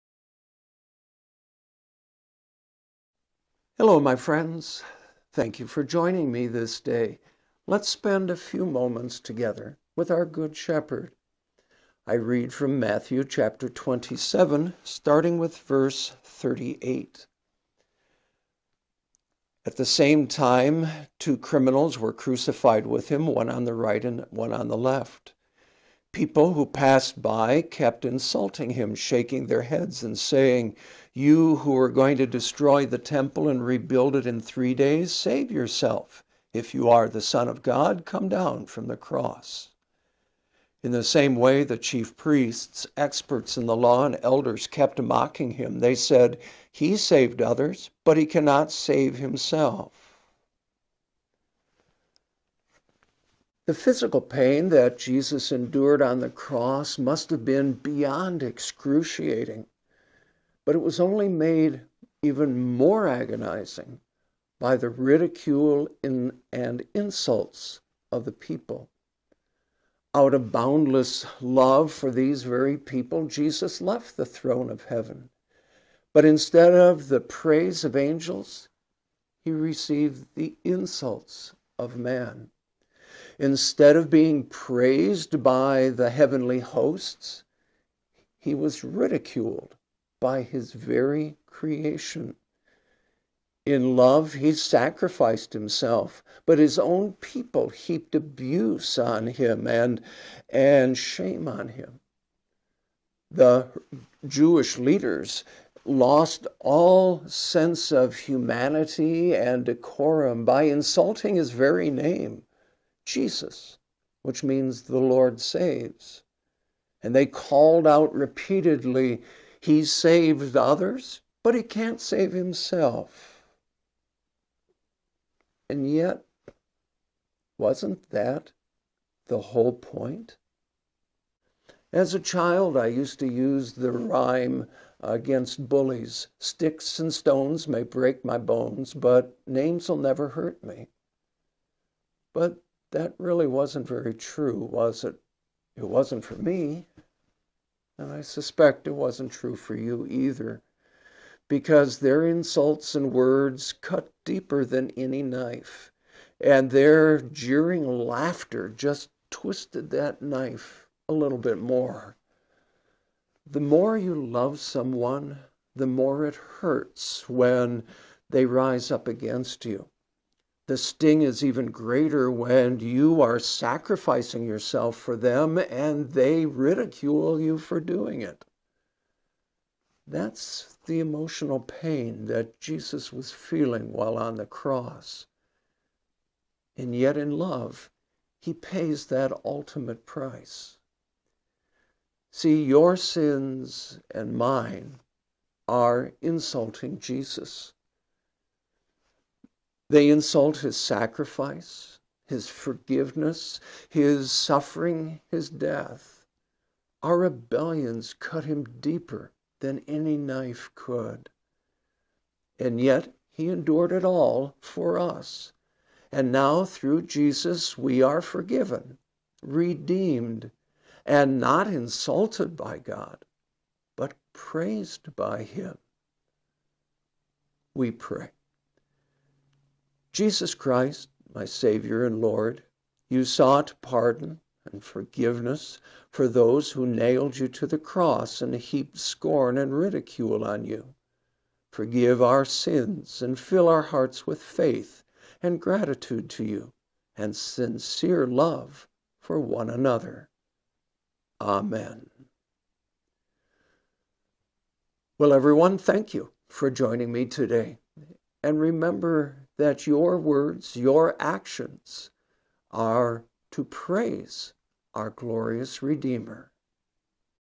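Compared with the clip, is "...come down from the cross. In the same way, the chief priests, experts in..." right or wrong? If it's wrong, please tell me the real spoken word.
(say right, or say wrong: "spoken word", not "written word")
right.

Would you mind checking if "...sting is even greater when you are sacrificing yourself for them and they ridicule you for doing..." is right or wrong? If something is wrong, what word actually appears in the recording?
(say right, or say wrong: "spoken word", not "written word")
right.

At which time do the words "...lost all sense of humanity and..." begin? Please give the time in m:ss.
1:45.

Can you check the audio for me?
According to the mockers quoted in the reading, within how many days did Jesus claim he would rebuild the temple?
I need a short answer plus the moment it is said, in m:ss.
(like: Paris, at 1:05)
3, at 0:34.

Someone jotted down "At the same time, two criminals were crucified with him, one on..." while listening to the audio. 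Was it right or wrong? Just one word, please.
right.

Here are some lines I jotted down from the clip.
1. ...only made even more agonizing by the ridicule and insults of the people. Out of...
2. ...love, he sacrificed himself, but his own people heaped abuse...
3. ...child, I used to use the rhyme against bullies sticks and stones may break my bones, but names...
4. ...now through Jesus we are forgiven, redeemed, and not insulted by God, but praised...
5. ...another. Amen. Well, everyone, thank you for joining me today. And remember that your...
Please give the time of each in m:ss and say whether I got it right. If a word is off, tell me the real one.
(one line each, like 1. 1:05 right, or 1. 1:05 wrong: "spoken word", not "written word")
1. 1:00 right
2. 1:33 right
3. 2:12 right
4. 3:36 right
5. 4:09 right.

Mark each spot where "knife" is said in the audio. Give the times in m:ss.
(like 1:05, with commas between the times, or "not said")
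2:35, 2:40, 3:30.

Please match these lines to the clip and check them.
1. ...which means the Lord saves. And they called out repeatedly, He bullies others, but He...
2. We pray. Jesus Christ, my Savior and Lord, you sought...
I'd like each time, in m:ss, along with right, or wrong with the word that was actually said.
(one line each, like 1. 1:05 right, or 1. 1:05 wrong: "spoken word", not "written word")
1. 1:54 wrong: "saves", not "bullies"
2. 3:47 right.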